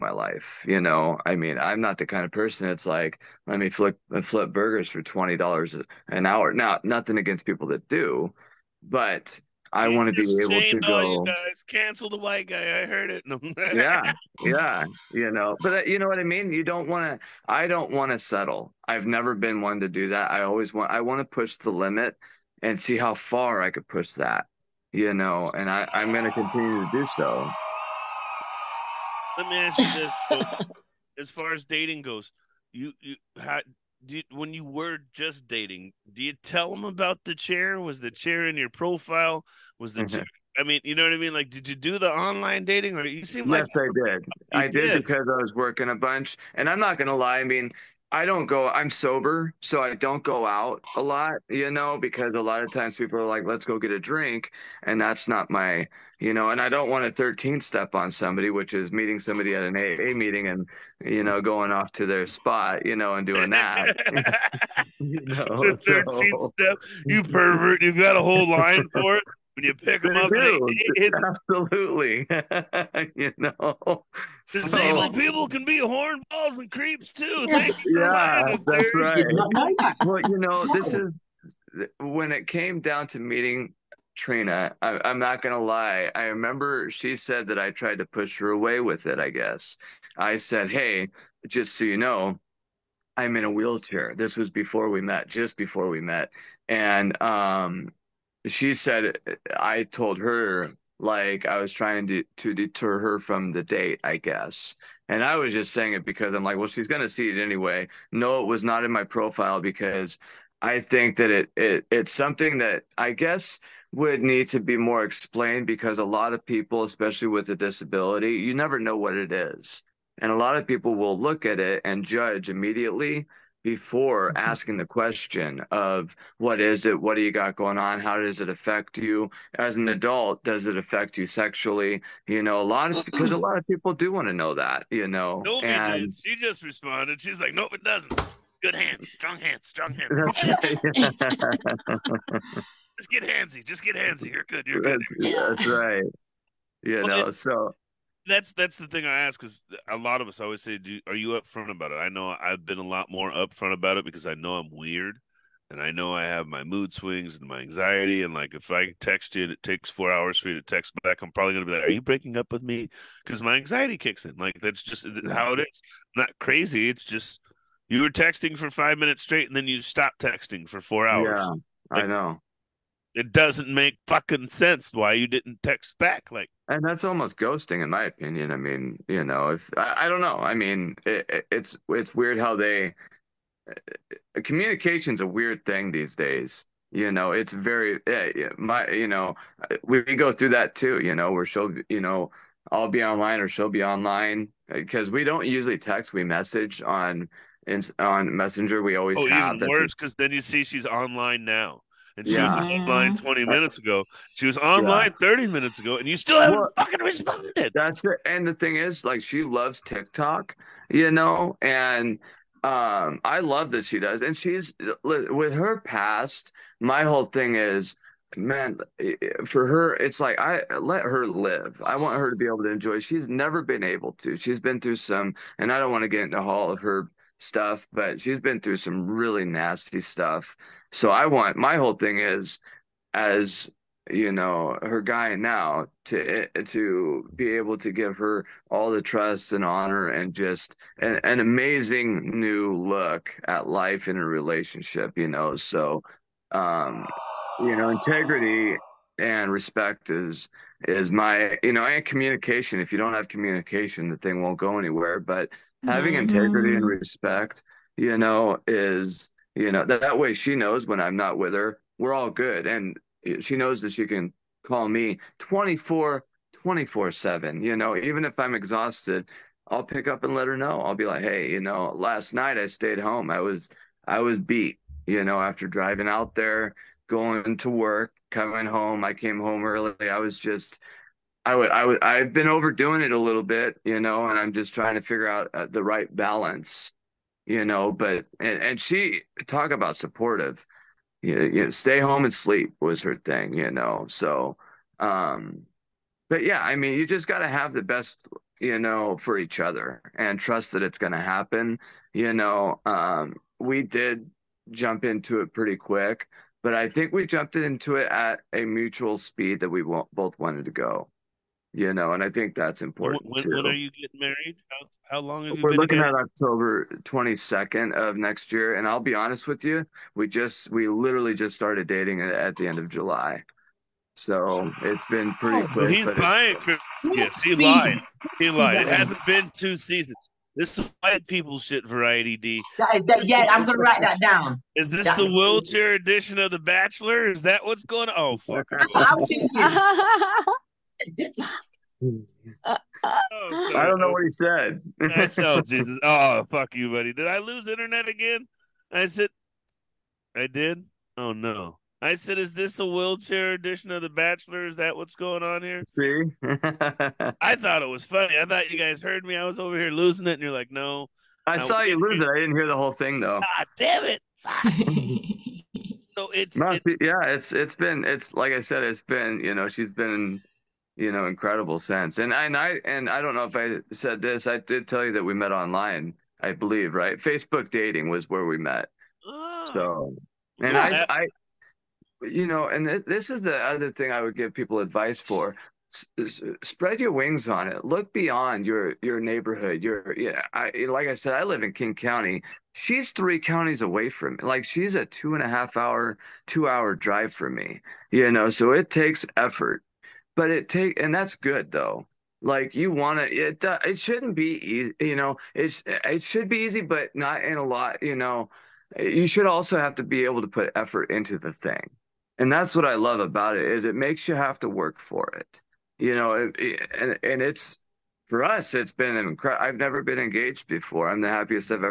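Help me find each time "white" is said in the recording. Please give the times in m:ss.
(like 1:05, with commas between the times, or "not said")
0:12, 5:31.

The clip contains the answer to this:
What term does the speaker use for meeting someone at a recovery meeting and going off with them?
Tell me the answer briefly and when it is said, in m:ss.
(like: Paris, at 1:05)
13 step, at 0:57.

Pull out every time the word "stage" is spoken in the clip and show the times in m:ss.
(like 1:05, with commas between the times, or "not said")
not said.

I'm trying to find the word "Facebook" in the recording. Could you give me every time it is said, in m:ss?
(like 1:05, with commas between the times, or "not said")
6:17.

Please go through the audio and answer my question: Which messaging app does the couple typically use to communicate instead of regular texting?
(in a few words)
Messenger.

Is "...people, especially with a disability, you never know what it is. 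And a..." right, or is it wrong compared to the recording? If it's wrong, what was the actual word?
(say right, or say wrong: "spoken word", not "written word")
right.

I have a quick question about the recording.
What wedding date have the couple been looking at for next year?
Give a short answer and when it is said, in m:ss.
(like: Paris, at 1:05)
October 22, at 5:16.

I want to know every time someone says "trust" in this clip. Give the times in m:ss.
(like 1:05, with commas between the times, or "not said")
3:59, 5:00.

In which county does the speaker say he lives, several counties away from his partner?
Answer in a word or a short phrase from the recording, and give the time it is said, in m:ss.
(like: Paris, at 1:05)
King County, at 6:31.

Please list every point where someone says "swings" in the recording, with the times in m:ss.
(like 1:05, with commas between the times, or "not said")
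2:36.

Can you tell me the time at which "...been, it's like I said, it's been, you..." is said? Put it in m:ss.
6:07.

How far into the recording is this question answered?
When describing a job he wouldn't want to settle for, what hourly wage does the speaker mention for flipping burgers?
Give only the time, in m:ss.
0:05.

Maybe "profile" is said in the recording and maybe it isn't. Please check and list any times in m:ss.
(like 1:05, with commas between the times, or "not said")
0:38, 1:49.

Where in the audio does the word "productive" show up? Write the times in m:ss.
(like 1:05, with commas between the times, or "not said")
not said.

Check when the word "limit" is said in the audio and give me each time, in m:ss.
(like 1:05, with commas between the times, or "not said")
0:21.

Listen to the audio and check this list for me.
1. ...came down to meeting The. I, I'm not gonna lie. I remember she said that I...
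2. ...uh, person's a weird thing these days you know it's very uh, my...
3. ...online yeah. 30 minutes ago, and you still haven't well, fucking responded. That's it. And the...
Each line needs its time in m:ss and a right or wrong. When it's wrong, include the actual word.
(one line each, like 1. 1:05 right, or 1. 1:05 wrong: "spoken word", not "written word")
1. 1:22 wrong: "Trina", not "The"
2. 3:03 wrong: "communication", not "person"
3. 3:24 right.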